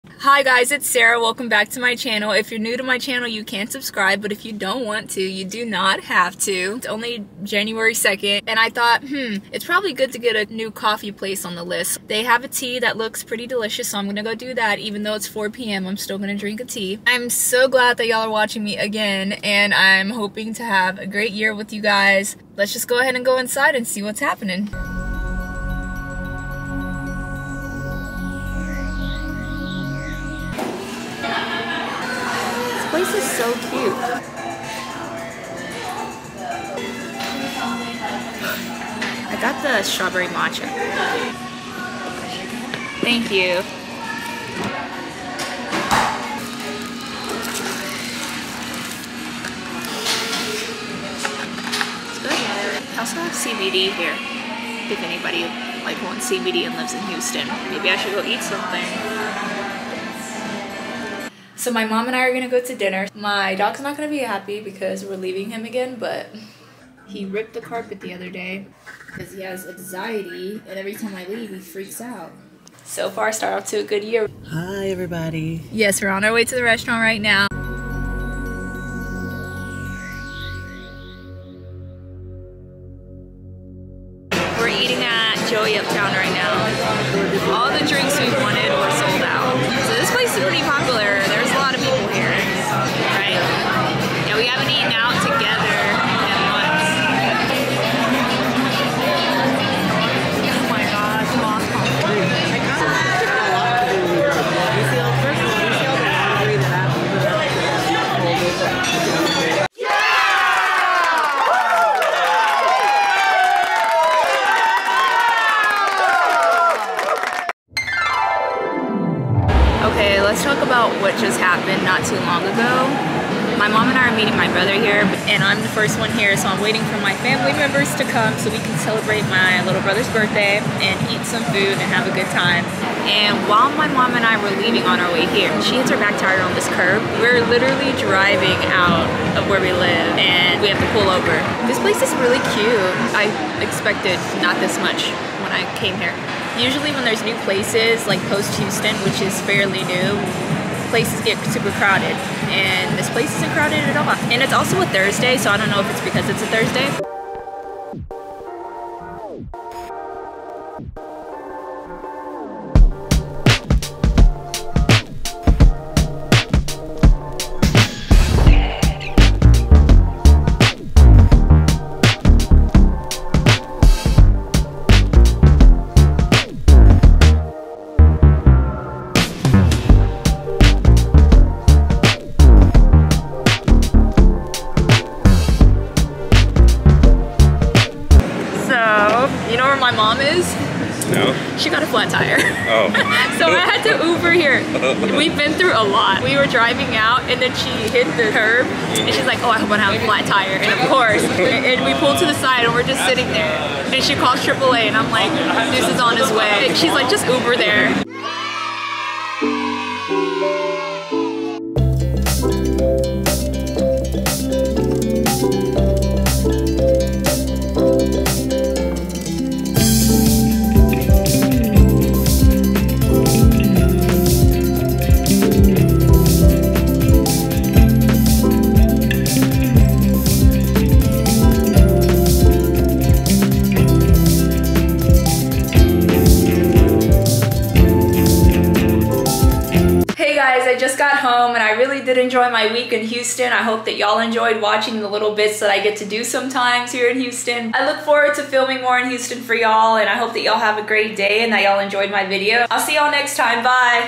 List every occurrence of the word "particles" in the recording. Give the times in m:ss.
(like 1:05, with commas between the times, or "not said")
not said.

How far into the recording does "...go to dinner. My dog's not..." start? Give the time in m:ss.
1:02.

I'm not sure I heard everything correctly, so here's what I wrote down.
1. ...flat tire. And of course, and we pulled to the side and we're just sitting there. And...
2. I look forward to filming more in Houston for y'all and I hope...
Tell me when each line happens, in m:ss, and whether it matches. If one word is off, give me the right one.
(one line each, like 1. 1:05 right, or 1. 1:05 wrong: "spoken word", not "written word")
1. 3:20 right
2. 4:07 right.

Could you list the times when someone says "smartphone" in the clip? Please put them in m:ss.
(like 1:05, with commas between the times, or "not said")
not said.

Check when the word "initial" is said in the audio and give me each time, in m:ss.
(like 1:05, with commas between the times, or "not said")
not said.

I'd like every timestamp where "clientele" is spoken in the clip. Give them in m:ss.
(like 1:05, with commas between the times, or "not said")
not said.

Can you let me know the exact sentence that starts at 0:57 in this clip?
Maybe I should go eat something.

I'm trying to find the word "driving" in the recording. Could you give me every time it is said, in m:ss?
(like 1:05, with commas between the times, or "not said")
2:17, 3:16.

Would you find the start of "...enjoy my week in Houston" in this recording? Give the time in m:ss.
4:02.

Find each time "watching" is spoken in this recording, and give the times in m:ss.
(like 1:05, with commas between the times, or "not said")
0:18, 4:04.